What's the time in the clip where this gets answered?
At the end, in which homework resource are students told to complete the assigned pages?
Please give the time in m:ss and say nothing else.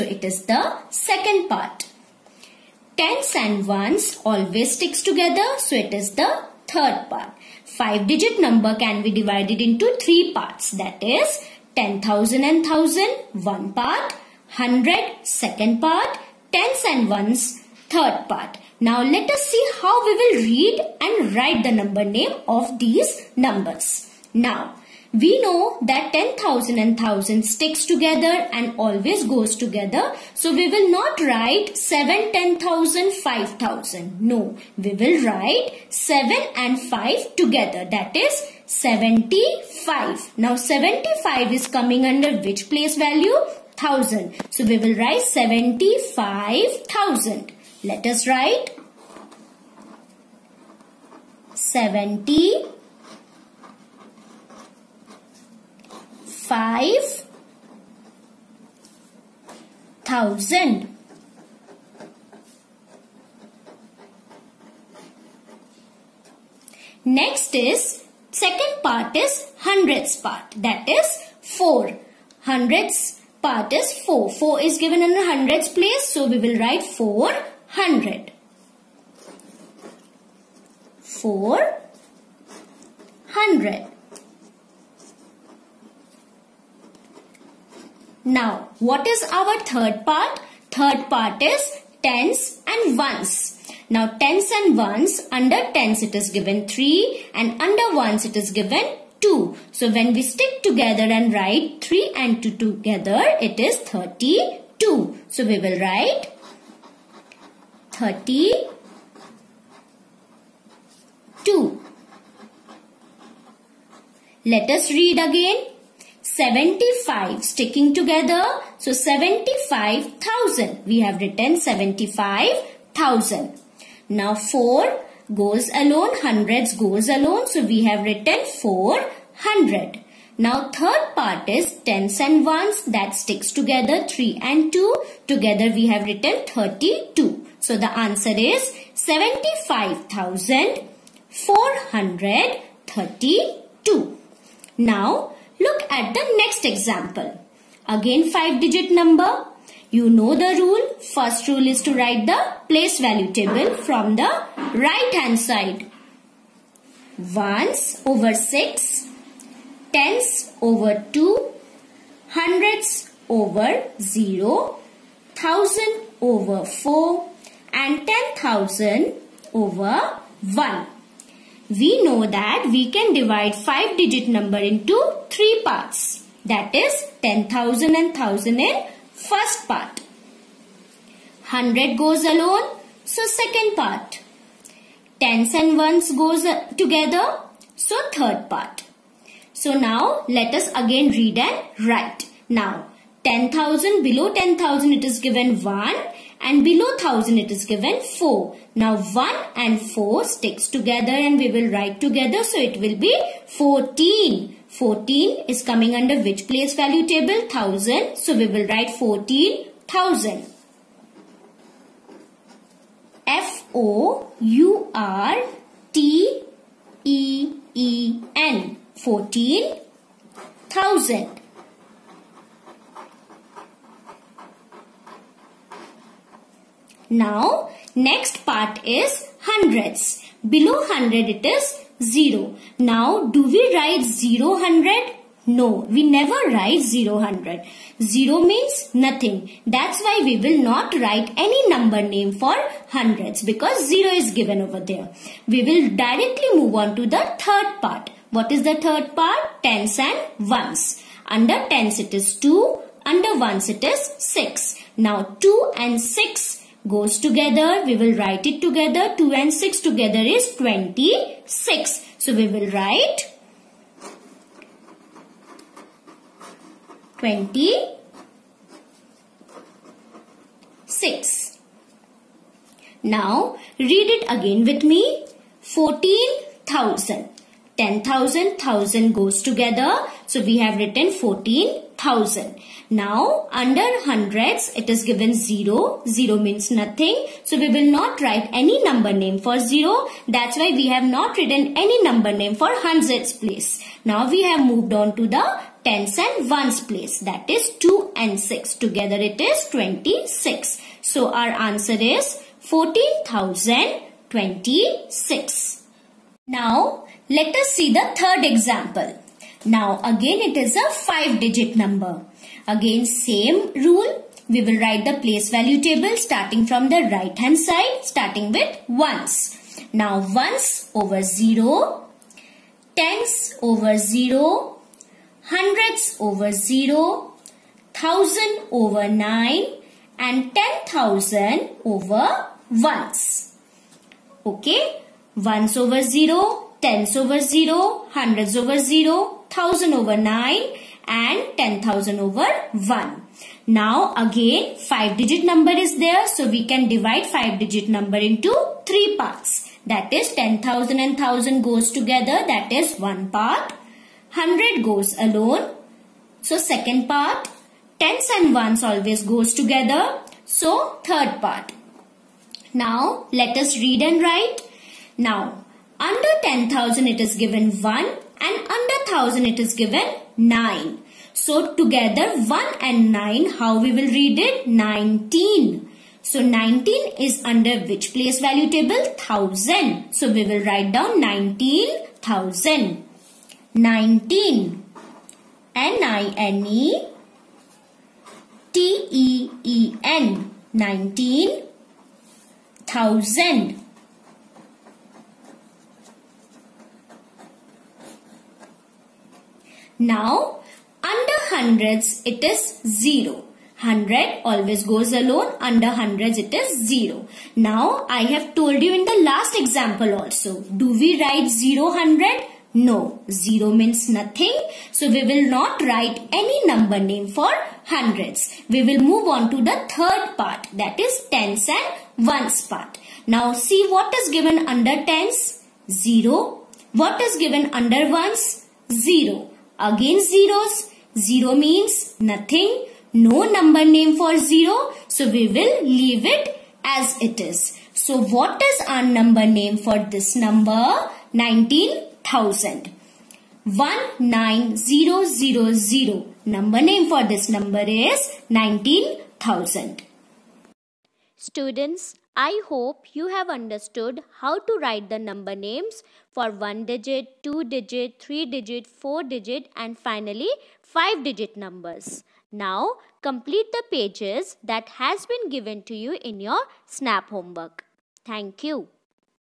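7:46.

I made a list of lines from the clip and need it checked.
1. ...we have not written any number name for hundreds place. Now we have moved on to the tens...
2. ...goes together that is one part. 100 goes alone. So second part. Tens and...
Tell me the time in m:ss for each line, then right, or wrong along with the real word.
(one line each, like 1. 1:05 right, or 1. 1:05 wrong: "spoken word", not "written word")
1. 4:50 right
2. 5:51 right.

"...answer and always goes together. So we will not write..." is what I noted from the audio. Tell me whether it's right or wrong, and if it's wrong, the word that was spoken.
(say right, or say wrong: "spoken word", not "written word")
wrong: "together", not "answer".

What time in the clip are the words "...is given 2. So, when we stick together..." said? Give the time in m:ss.
1:38.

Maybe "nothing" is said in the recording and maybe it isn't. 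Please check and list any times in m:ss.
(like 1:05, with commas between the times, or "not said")
3:58, 4:46, 6:54, 7:12.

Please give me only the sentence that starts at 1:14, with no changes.
4 is given in the hundreds place.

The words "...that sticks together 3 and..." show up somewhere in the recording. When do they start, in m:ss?
2:12.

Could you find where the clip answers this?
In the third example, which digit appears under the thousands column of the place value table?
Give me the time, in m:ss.
5:27.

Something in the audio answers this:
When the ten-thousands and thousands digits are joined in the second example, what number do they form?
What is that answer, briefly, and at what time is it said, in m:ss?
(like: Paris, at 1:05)
14, at 3:22.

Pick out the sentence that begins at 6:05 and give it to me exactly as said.
Now under 10,000 it is given 1 and under 1000 it is given 9.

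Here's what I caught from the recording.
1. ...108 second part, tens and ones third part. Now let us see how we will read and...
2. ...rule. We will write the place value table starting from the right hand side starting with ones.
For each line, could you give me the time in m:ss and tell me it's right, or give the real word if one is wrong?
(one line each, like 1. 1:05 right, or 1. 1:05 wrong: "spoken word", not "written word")
1. 0:14 wrong: "100", not "108"
2. 5:13 right.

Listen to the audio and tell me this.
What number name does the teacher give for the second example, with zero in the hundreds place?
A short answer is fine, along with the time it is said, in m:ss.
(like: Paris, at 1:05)
14,026, at 5:01.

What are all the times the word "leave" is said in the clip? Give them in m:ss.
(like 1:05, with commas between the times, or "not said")
7:15.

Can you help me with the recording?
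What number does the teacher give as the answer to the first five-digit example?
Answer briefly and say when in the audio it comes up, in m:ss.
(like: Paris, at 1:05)
75,432, at 2:17.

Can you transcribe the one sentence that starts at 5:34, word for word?
Okay, ones over 0, tens over 0, hundreds over 0, 1000 over 9 and 10,000 over 1.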